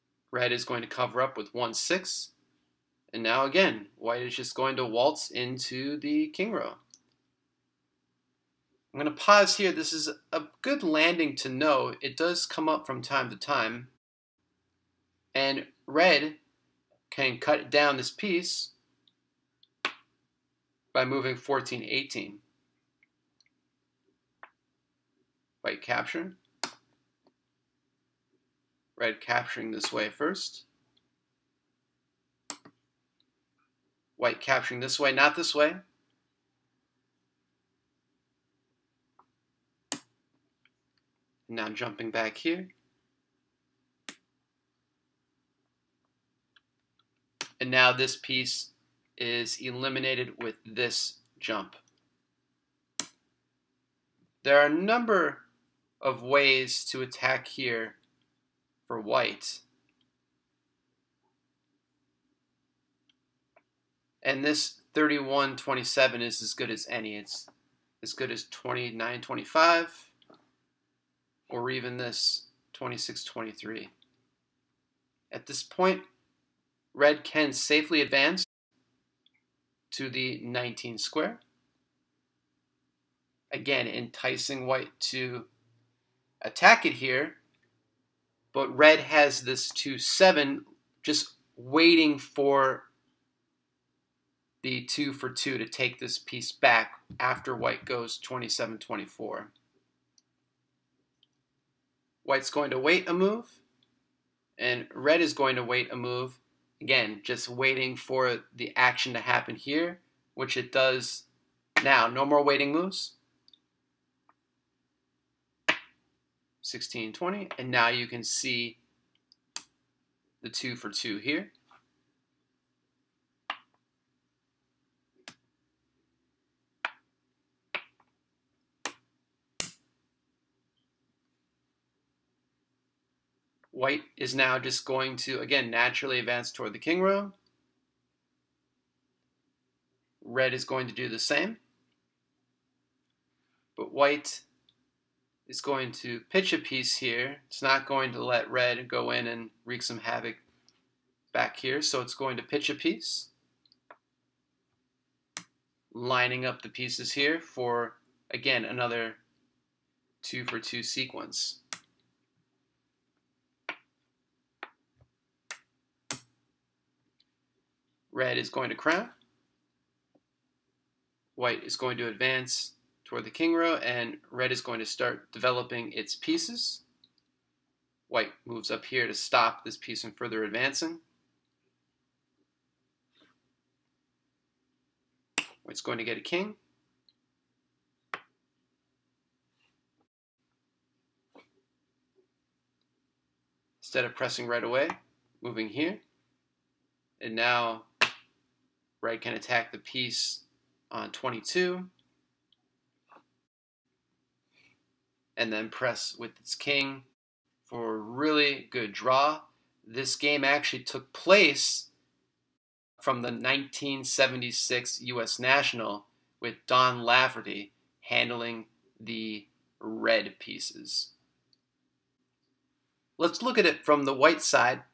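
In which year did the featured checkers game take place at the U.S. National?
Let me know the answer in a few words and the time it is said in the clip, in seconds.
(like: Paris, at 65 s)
1976, at 213 s.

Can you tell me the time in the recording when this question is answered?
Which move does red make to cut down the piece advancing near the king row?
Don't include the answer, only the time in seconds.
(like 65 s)
21 s.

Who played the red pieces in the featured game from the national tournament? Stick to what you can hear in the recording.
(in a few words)
Don Lafferty.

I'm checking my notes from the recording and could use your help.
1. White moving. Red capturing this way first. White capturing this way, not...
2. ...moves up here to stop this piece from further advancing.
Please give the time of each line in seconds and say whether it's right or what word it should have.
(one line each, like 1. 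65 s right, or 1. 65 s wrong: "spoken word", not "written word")
1. 25 s wrong: "capturing", not "moving"
2. 178 s right.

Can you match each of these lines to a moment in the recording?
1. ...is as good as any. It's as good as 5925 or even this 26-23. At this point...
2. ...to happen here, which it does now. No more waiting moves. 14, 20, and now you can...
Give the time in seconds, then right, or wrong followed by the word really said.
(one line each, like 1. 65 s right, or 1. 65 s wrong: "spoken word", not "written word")
1. 66 s wrong: "2925", not "5925"
2. 109 s wrong: "16", not "14".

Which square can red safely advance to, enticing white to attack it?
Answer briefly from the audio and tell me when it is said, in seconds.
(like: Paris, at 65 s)
19, at 80 s.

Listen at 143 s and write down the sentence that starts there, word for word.
But white is going to pitch a piece here.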